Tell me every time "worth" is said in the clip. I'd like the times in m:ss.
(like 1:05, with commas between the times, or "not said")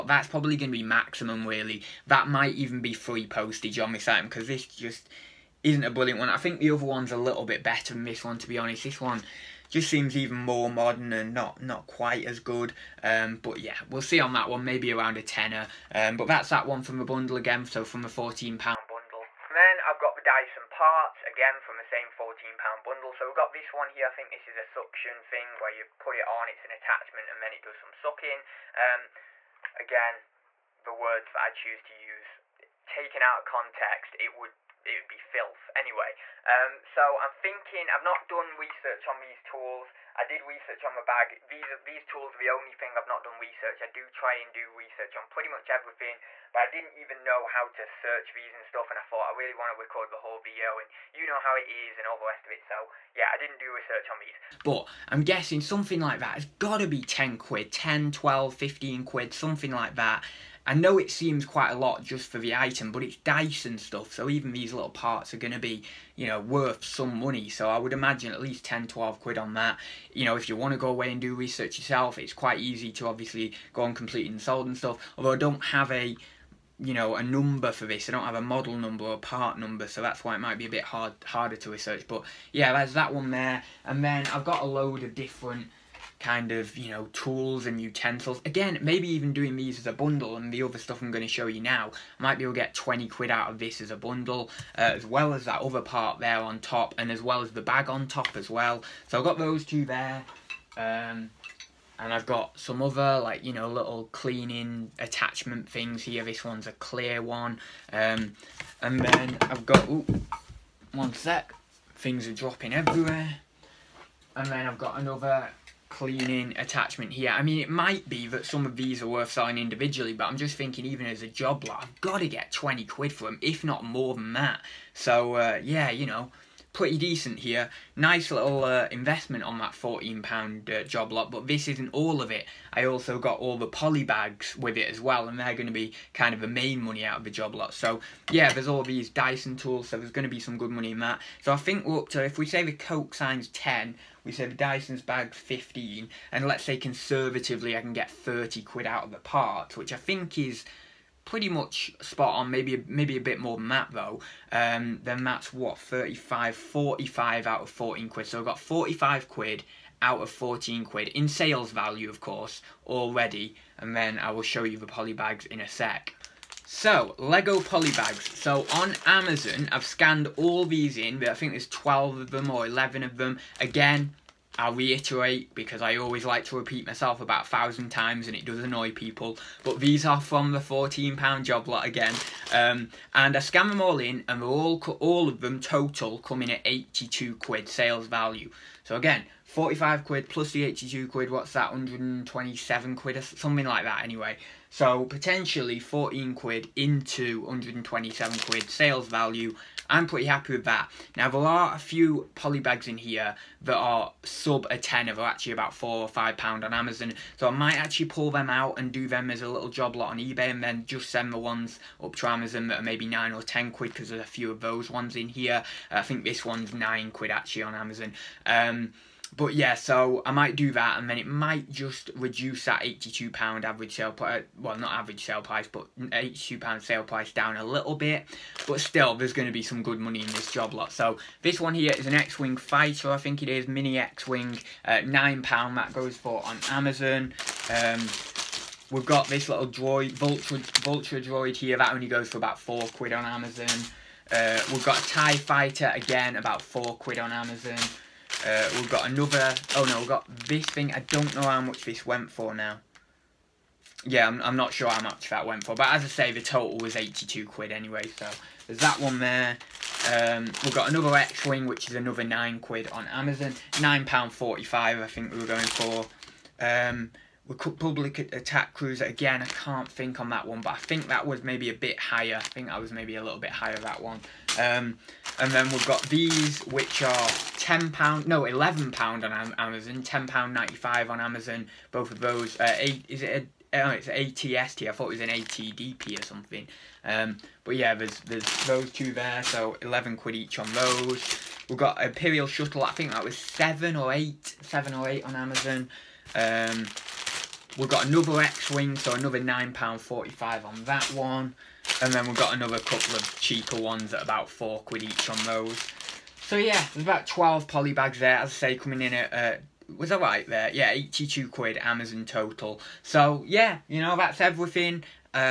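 1:06, 1:59.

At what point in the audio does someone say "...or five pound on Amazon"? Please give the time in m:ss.
3:25.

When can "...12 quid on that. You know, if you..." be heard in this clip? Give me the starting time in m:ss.
1:08.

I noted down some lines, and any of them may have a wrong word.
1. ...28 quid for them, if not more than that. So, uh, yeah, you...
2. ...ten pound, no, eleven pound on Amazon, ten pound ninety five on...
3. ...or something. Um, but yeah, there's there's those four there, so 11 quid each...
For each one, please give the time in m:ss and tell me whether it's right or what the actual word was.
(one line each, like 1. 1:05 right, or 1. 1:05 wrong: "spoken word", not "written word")
1. 2:02 wrong: "20", not "28"
2. 4:37 right
3. 4:46 wrong: "two", not "four".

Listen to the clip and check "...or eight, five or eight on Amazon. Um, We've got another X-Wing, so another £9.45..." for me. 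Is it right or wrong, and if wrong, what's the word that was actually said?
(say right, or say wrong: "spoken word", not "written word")
wrong: "seven", not "five".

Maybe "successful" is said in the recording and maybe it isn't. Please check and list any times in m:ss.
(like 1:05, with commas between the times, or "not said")
not said.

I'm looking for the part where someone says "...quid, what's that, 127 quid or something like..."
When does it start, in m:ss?
3:11.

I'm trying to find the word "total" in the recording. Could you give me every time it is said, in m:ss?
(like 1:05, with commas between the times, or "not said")
3:05, 4:16, 5:12.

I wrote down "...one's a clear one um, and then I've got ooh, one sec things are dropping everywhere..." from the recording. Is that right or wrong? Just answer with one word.
right.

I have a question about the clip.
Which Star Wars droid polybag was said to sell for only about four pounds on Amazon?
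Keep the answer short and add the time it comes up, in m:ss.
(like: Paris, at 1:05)
Vulture droid, at 4:00.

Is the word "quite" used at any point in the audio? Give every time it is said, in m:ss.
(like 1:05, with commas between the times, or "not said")
0:11, 1:01, 1:12.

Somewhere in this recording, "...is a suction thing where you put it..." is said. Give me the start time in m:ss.
0:24.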